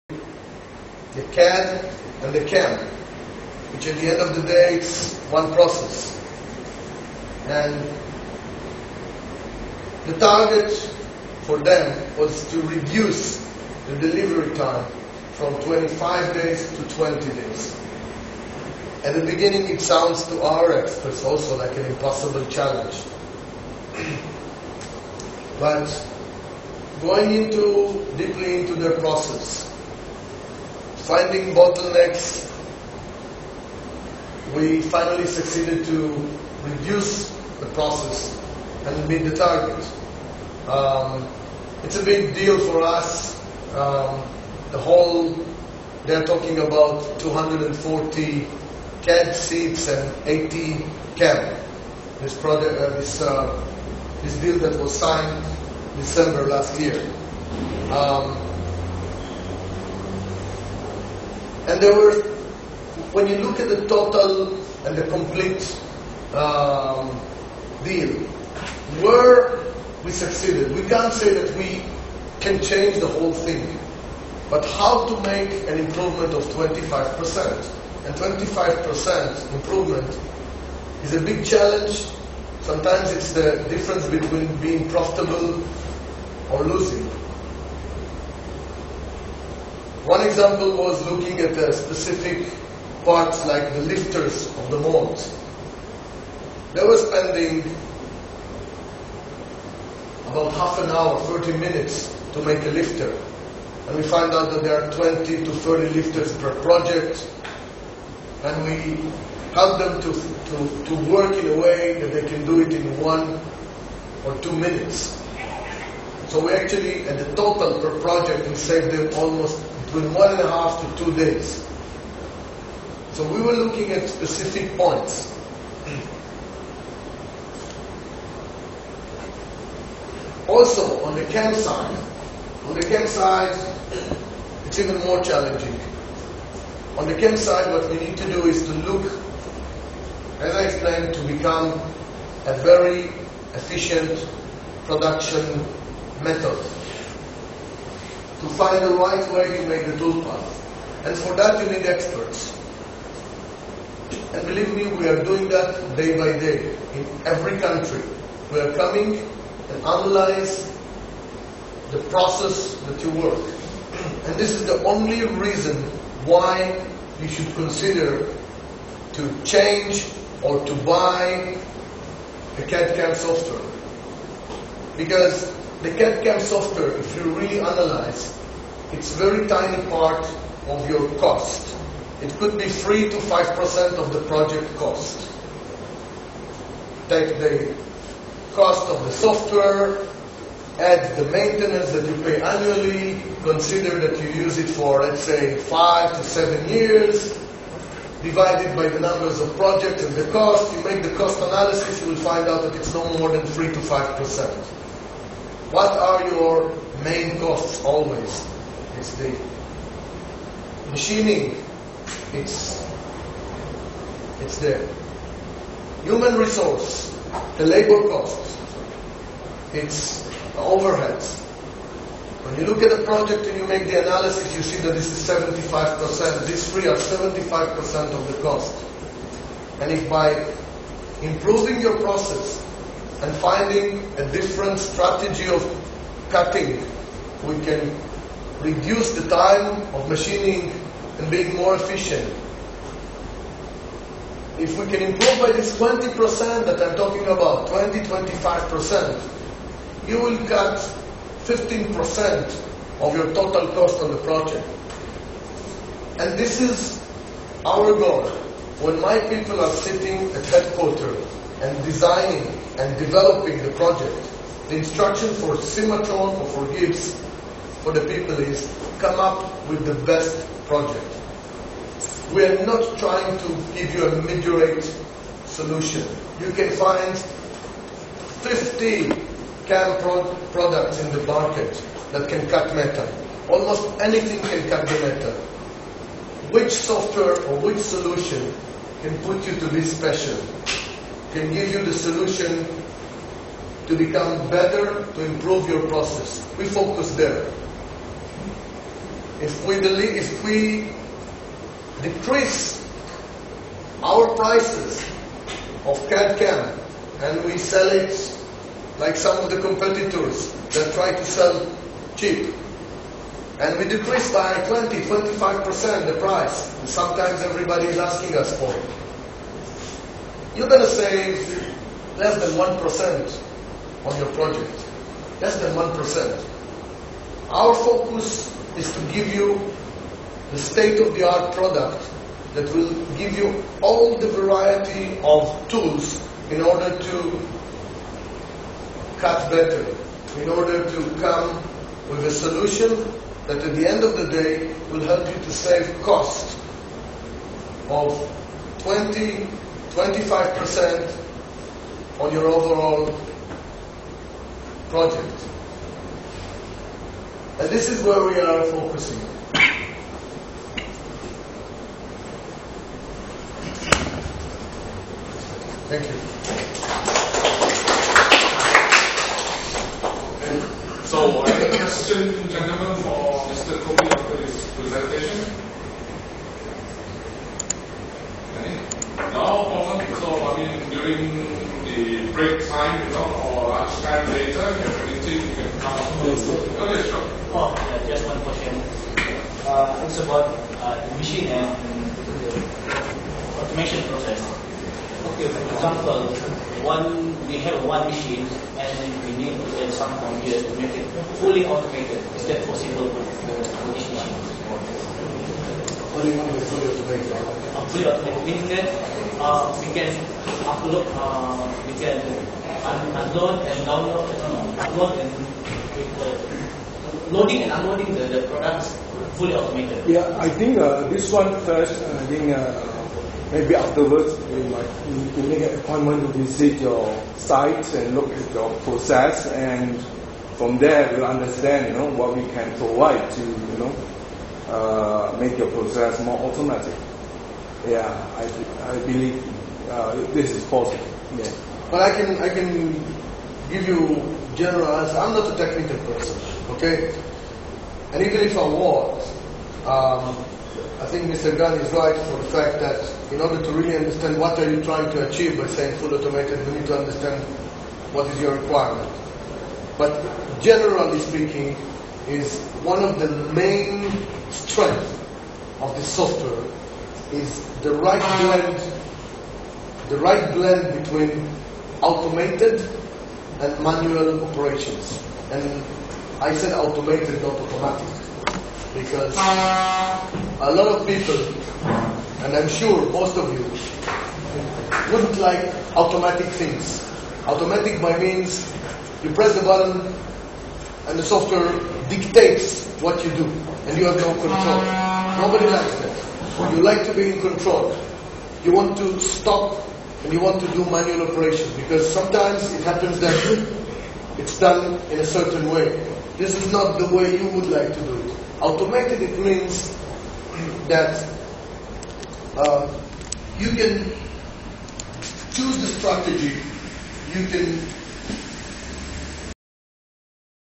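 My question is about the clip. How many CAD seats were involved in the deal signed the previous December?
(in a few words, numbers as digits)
240.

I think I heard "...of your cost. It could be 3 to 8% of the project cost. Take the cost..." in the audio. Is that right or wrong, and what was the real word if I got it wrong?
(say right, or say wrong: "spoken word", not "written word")
wrong: "5", not "8".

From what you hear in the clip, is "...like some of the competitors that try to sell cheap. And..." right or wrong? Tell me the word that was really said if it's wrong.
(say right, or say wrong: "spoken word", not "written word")
right.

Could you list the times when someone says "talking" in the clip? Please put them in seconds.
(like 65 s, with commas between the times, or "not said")
46 s, 246 s.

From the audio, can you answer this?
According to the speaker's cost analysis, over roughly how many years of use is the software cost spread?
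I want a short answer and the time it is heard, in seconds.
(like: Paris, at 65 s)
5 to 7 years, at 195 s.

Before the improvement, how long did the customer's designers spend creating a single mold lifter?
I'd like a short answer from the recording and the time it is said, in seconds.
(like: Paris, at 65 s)
30 minutes, at 101 s.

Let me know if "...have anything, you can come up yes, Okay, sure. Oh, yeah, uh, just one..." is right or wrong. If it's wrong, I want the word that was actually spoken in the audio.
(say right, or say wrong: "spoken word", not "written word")
right.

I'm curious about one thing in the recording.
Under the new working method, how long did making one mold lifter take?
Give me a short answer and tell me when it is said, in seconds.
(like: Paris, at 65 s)
one or two minutes, at 112 s.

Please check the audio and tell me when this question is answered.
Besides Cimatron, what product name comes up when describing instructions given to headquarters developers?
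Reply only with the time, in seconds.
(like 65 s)
266 s.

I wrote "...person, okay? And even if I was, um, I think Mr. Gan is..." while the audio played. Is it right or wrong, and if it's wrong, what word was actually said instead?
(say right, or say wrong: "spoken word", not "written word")
right.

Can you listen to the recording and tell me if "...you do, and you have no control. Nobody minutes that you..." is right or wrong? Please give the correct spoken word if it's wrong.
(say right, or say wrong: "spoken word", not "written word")
wrong: "likes", not "minutes".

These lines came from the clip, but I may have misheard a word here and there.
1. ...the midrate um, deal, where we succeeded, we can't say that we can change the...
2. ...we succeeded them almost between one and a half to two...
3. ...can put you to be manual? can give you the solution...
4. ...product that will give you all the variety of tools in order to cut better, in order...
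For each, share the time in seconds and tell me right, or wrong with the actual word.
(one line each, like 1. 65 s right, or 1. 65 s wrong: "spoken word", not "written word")
1. 64 s wrong: "complete", not "midrate"
2. 118 s wrong: "saved", not "succeeded"
3. 289 s wrong: "special", not "manual"
4. 331 s right.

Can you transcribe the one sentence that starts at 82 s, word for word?
Sometimes it's the difference between being profitable or losing.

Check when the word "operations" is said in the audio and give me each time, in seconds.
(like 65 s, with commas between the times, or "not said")
474 s, 501 s.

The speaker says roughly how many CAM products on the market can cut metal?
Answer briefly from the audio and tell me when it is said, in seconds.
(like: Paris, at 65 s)
50, at 278 s.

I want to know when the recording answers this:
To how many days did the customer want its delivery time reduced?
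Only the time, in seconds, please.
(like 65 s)
16 s.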